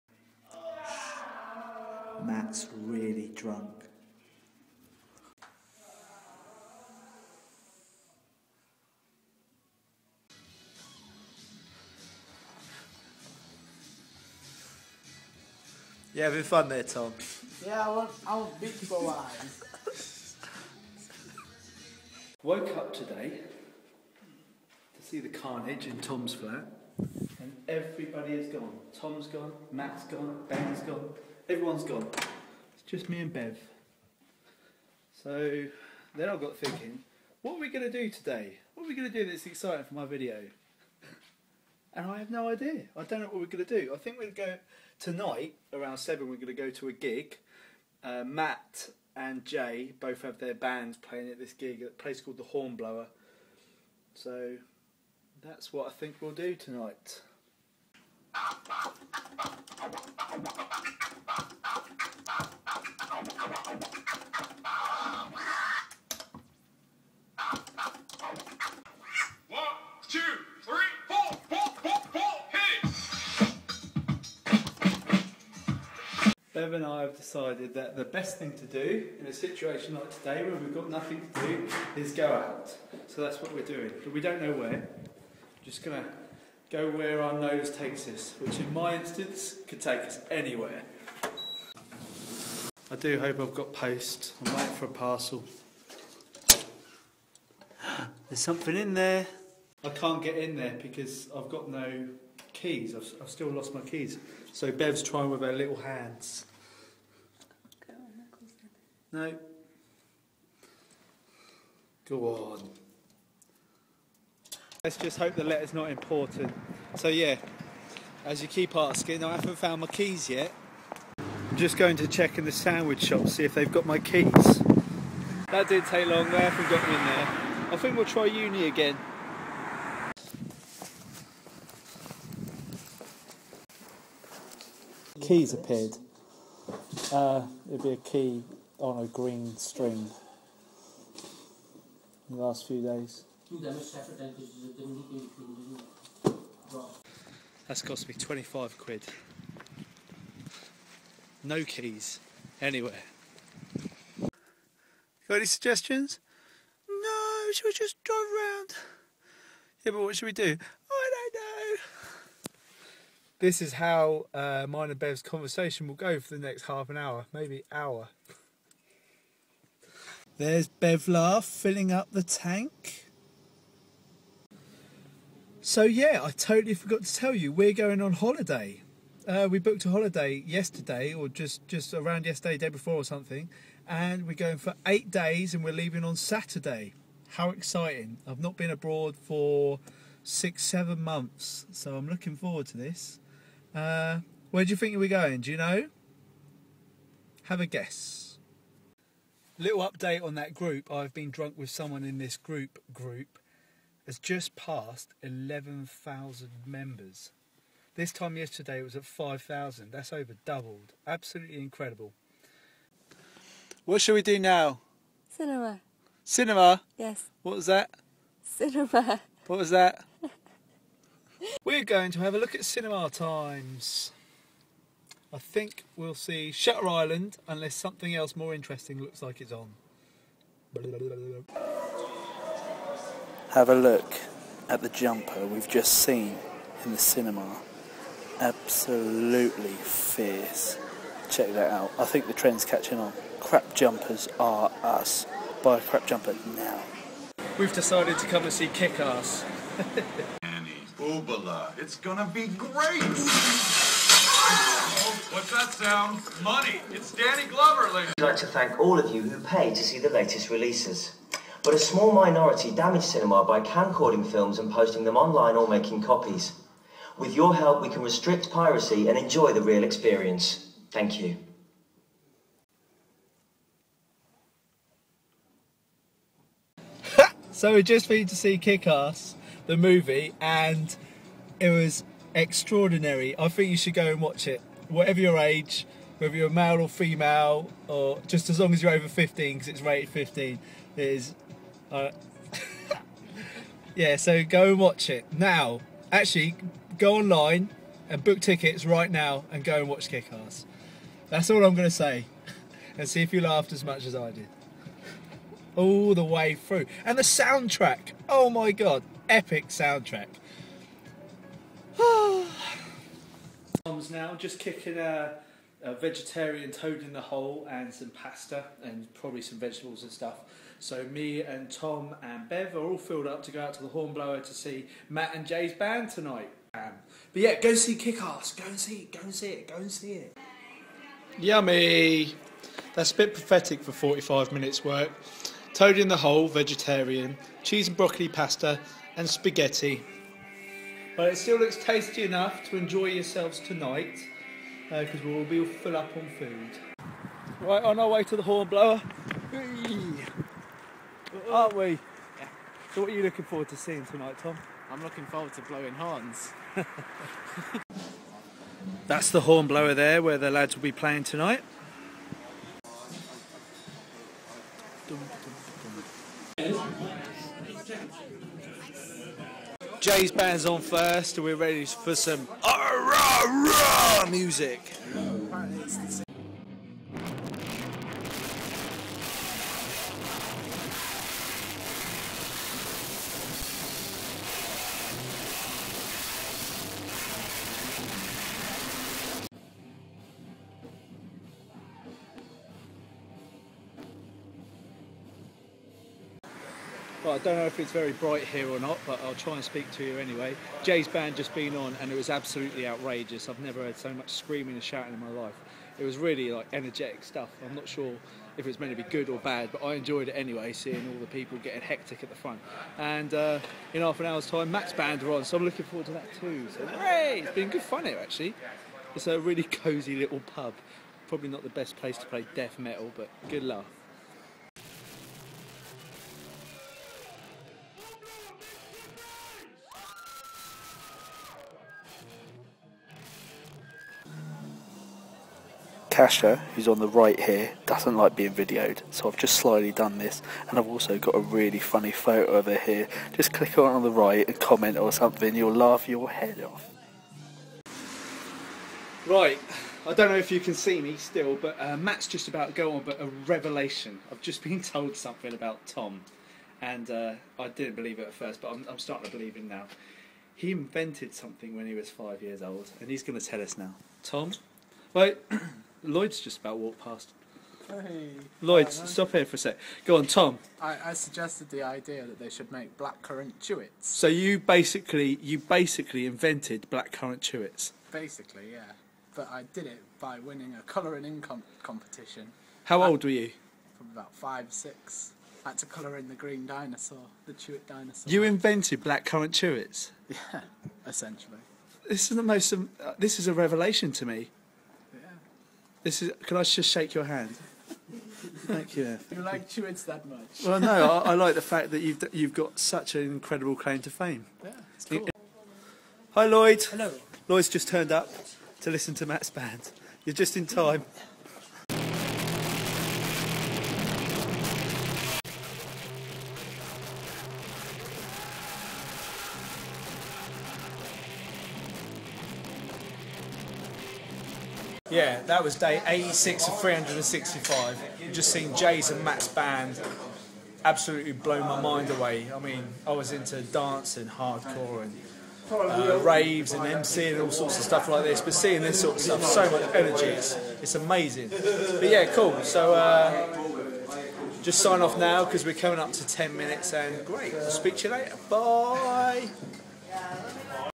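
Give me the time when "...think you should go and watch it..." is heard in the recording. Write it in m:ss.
4:43.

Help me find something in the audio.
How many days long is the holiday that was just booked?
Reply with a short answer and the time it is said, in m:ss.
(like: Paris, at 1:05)
8 days, at 3:04.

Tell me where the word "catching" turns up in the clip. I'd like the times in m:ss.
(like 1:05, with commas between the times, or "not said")
4:02.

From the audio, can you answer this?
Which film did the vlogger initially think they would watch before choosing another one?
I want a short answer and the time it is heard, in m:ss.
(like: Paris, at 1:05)
Shutter Island, at 3:46.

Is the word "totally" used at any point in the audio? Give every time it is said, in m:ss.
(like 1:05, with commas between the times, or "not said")
2:56.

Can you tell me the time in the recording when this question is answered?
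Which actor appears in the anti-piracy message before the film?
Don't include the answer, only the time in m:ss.
4:17.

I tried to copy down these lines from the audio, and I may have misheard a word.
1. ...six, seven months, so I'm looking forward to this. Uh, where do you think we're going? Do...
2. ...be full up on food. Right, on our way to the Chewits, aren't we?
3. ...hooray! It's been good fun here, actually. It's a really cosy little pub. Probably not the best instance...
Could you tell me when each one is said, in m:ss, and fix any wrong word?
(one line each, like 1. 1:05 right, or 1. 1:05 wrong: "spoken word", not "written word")
1. 3:10 right
2. 5:45 wrong: "Hornblower", not "Chewits"
3. 6:56 wrong: "place", not "instance".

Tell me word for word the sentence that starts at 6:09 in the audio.
Jay's band's on first, and we're ready for some rah, ra music.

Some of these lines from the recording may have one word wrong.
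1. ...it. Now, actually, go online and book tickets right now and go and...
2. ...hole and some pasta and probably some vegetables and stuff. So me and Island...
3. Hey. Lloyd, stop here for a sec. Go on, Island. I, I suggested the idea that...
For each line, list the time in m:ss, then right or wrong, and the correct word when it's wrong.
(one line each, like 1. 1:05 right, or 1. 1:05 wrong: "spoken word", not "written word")
1. 4:55 right
2. 5:17 wrong: "Tom", not "Island"
3. 7:47 wrong: "Tom", not "Island".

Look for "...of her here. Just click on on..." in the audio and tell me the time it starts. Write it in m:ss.
7:22.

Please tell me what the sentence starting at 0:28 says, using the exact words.
Tom's gone, Matt's gone, Ben's gone.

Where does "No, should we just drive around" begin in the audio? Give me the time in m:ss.
2:36.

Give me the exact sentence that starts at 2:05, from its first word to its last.
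That did take long, they haven't got me in there.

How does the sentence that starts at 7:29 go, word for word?
Right, I don't know if you can see me still, but uh, Matt's just about to go on, but a revelation.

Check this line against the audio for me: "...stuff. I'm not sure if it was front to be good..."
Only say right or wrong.
wrong.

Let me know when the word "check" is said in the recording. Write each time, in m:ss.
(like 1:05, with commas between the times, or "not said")
2:02, 4:01.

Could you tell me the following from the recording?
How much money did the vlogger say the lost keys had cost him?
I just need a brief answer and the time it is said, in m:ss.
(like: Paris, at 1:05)
25 quid, at 2:28.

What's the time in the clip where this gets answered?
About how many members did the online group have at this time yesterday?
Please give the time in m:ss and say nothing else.
3:29.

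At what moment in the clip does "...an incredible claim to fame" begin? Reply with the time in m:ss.
8:23.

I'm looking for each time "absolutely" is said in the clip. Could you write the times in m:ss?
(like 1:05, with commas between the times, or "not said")
3:31, 3:58, 6:42, 8:50.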